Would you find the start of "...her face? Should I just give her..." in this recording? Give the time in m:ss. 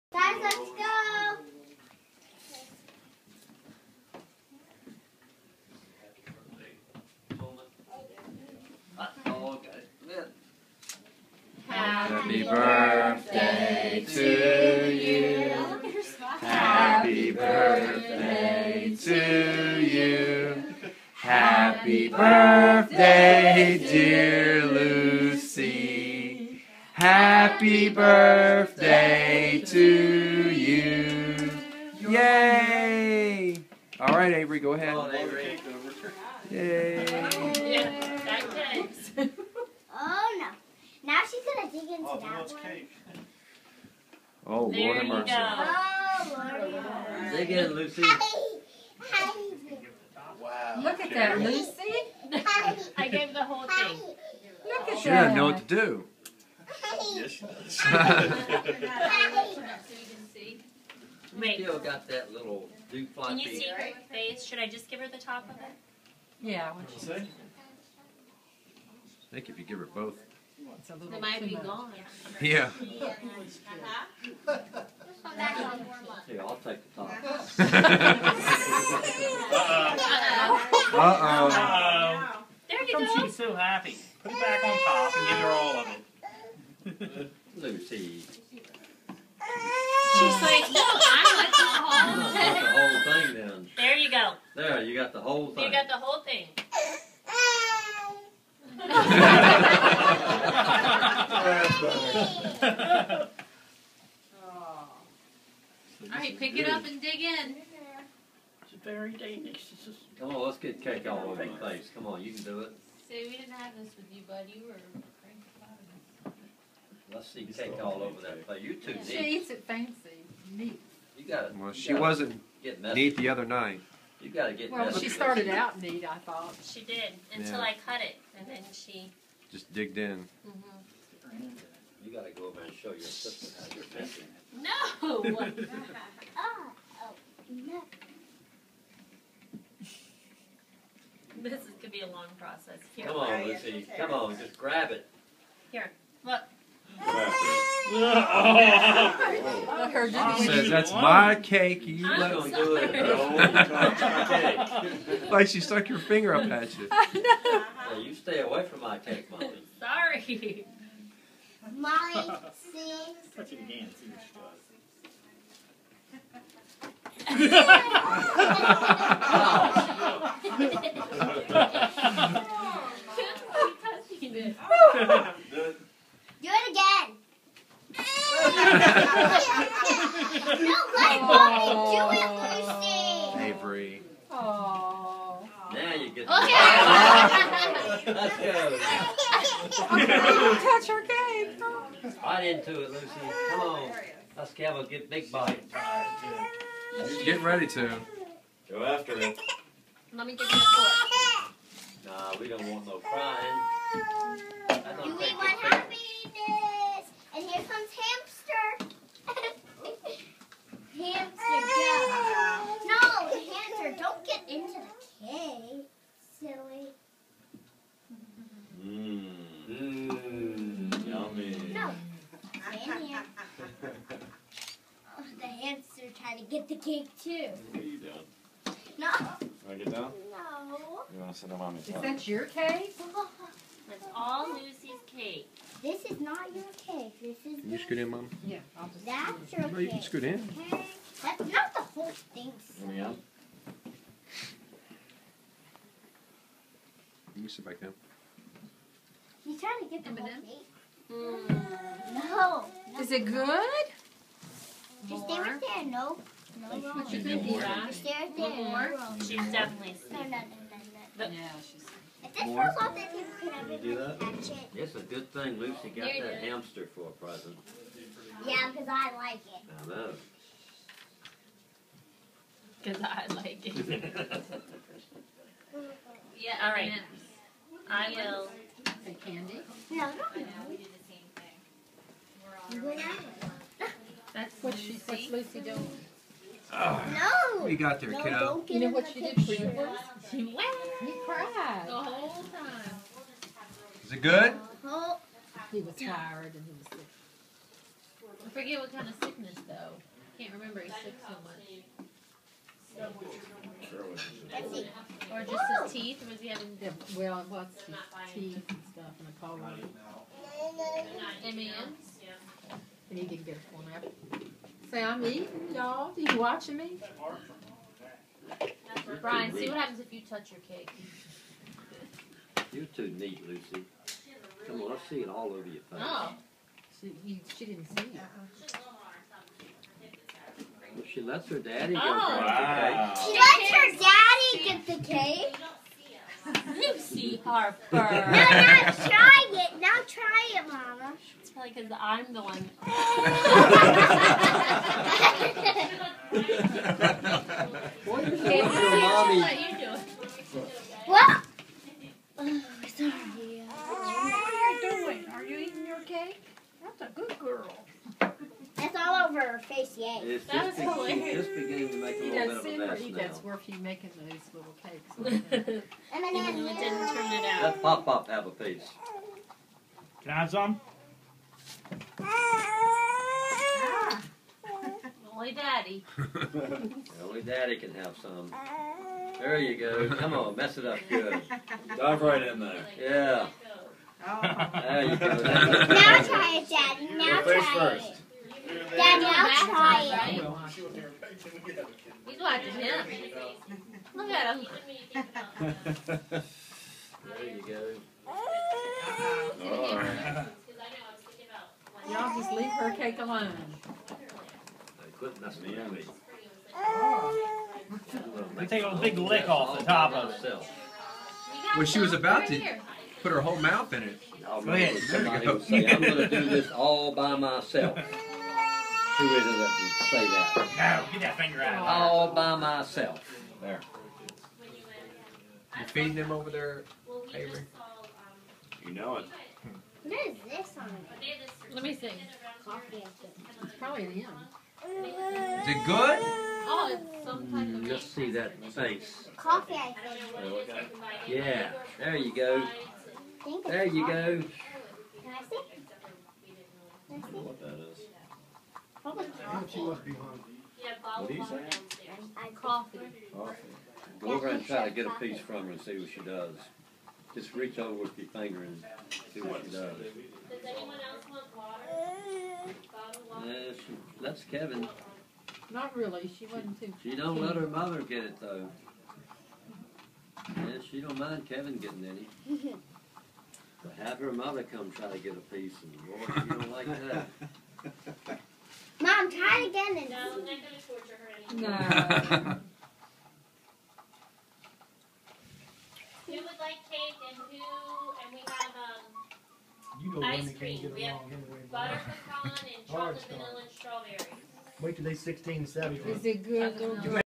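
1:03.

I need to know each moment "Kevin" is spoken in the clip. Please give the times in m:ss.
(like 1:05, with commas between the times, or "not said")
7:44, 7:51.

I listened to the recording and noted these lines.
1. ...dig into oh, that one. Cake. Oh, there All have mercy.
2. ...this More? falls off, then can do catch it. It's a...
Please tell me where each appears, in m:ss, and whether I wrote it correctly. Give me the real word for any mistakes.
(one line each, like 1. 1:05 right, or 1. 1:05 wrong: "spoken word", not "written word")
1. 0:41 wrong: "Lord", not "All"
2. 4:22 right.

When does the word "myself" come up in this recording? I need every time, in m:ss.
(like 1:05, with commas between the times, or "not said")
6:57, 7:02.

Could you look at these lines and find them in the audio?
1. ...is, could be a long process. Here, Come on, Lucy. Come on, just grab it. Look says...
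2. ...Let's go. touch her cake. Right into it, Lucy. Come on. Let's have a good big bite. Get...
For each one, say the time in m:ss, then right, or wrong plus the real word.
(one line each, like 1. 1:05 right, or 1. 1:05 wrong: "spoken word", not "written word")
1. 2:21 right
2. 3:08 right.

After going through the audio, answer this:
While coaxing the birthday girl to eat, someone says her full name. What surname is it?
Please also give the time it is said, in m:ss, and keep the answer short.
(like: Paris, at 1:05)
Harper, at 5:37.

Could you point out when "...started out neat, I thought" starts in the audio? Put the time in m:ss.
2:05.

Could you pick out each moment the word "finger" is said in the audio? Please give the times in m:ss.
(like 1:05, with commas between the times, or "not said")
2:35, 7:01, 7:38.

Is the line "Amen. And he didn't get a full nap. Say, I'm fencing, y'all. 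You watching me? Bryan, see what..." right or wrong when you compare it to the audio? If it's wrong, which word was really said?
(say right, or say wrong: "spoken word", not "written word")
wrong: "eating", not "fencing".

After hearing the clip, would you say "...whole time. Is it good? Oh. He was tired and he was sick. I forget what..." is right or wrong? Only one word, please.
right.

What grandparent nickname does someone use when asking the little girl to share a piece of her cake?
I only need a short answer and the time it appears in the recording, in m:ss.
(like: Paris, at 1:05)
pop-pop, at 6:07.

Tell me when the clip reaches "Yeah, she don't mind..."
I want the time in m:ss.
7:50.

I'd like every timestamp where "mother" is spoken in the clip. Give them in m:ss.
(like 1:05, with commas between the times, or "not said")
7:47, 7:54.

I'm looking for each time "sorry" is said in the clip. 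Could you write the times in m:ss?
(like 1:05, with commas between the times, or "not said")
2:39, 5:52.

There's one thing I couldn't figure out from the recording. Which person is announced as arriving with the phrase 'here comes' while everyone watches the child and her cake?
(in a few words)
Harry.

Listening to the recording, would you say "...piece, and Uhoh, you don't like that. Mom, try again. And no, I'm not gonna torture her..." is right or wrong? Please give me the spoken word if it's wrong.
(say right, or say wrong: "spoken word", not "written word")
wrong: "Lord", not "Uhoh".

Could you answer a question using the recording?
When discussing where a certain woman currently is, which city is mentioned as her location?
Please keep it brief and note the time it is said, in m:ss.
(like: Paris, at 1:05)
New Orleans, at 4:17.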